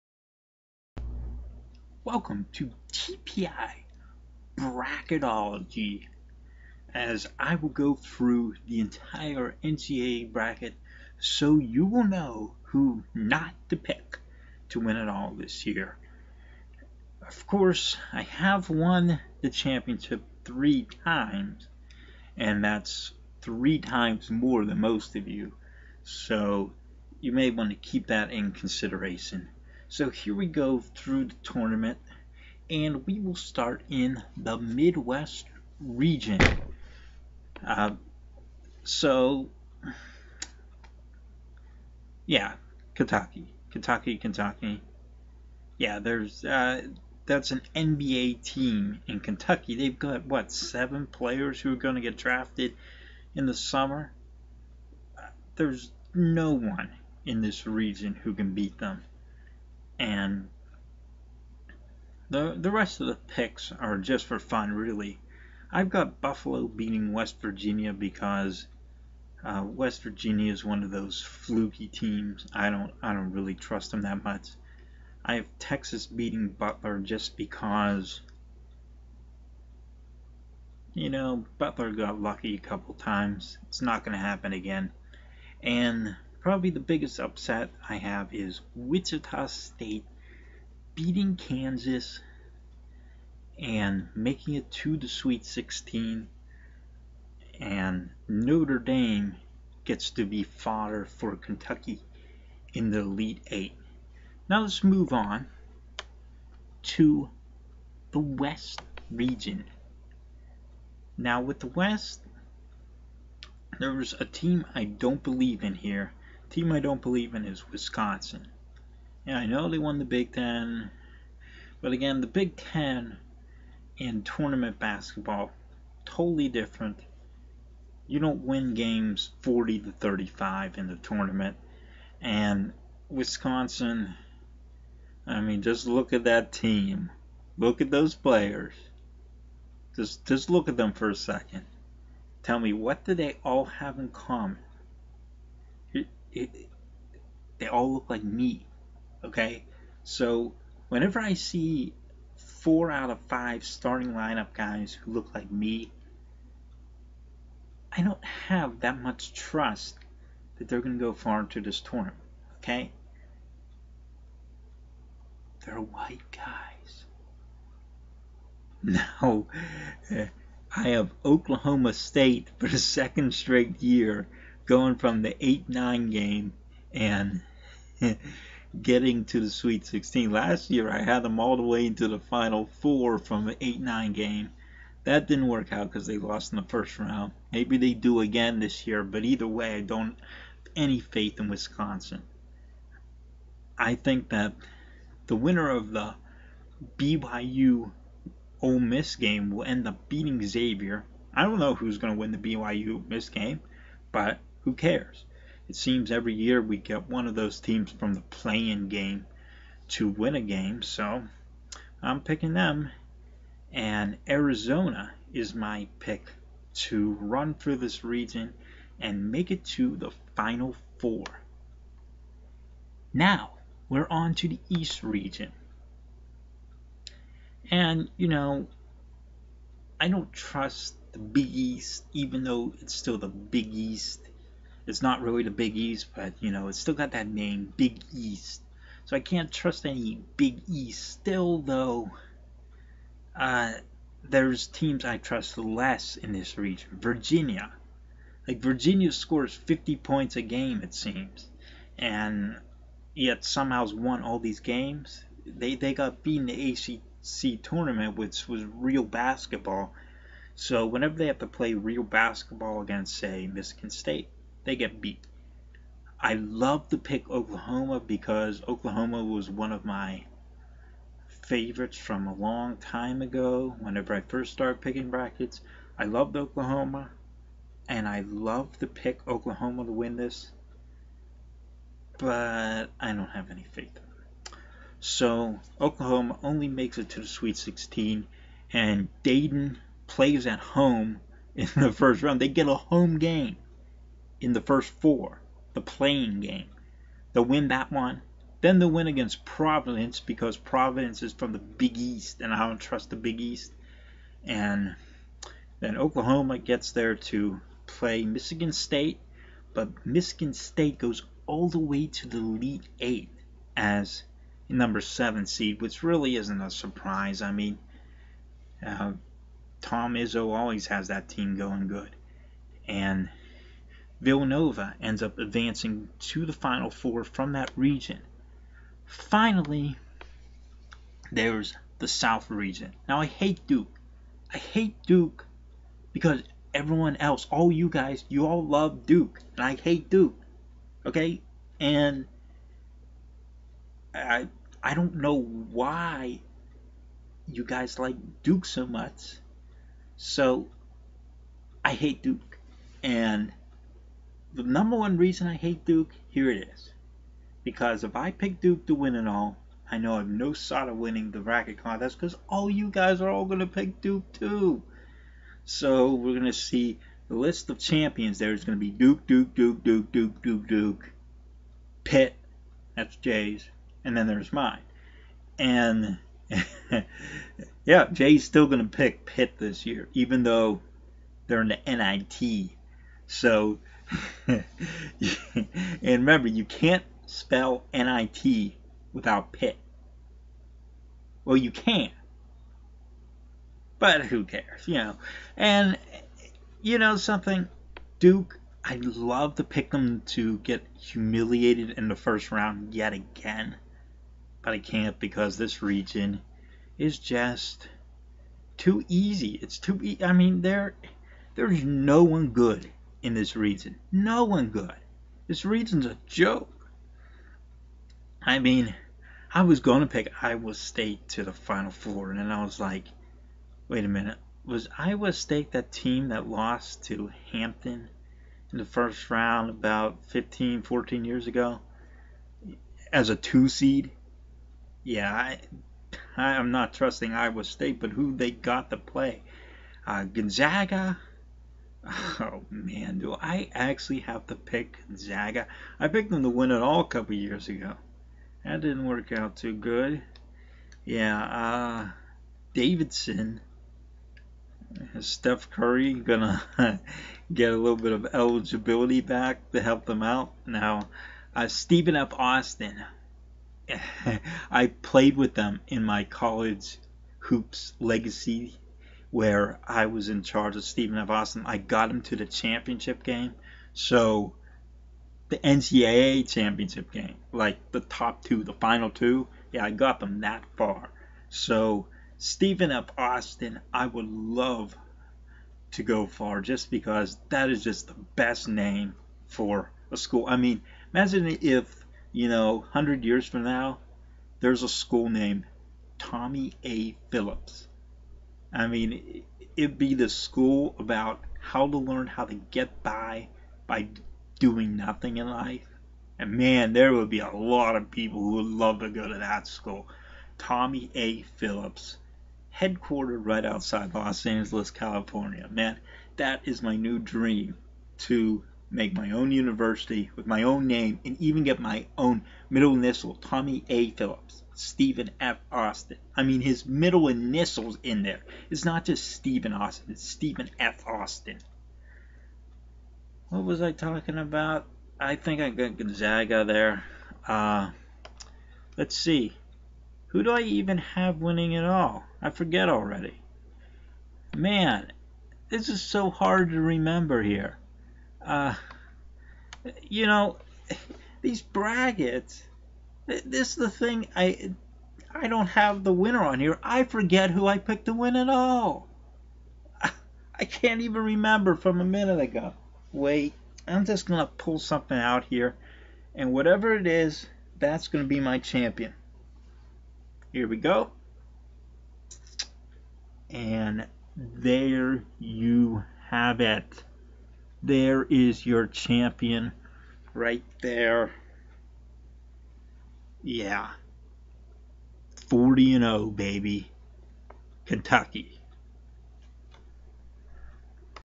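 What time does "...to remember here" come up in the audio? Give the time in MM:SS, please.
09:06.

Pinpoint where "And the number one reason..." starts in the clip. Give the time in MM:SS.
05:53.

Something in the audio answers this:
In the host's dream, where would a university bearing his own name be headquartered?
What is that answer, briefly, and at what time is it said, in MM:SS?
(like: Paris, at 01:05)
Los Angeles, California, at 08:34.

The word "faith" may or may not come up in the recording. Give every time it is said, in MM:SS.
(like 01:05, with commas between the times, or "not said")
03:11, 04:43.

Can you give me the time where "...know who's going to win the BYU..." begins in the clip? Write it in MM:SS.
03:21.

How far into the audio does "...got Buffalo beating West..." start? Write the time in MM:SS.
01:05.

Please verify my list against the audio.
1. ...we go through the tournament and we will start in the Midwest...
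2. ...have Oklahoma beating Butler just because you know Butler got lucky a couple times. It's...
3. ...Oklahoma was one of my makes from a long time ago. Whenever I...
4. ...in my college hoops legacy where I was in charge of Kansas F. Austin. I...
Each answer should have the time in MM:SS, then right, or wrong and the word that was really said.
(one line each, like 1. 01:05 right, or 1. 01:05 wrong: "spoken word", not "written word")
1. 00:30 right
2. 01:15 wrong: "Texas", not "Oklahoma"
3. 04:28 wrong: "favorites", not "makes"
4. 07:45 wrong: "Stephen", not "Kansas".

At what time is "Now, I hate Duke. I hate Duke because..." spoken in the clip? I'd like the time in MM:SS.
05:33.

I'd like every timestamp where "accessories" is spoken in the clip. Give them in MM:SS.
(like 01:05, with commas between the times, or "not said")
not said.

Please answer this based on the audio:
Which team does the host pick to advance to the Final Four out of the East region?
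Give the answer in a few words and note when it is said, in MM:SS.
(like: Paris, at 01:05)
Villanova, at 05:24.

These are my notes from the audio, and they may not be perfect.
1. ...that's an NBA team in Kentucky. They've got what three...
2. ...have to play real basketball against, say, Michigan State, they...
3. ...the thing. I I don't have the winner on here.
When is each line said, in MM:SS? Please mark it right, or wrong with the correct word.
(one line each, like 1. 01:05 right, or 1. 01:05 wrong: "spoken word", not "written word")
1. 00:47 wrong: "seven", not "three"
2. 04:21 right
3. 09:13 right.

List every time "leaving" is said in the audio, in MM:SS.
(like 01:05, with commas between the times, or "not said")
not said.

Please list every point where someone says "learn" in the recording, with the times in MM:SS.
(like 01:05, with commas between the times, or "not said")
08:21.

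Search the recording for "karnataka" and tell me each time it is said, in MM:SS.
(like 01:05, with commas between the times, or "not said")
not said.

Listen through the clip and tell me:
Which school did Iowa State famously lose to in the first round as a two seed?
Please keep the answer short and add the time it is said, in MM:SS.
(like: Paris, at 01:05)
Hampton, at 07:07.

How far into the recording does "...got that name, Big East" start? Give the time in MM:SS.
03:56.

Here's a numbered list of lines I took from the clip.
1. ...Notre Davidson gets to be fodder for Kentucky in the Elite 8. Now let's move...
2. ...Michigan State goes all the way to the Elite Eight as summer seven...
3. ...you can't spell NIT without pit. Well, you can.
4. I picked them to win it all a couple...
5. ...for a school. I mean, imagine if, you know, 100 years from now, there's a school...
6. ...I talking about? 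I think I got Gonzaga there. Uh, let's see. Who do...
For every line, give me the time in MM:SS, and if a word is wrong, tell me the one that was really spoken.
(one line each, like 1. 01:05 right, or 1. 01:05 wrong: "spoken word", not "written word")
1. 01:38 wrong: "Dame", not "Davidson"
2. 05:10 wrong: "number", not "summer"
3. 06:26 right
4. 07:25 right
5. 08:09 right
6. 08:53 right.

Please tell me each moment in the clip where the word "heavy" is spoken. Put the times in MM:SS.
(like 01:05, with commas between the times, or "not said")
not said.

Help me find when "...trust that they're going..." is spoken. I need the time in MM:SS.
02:39.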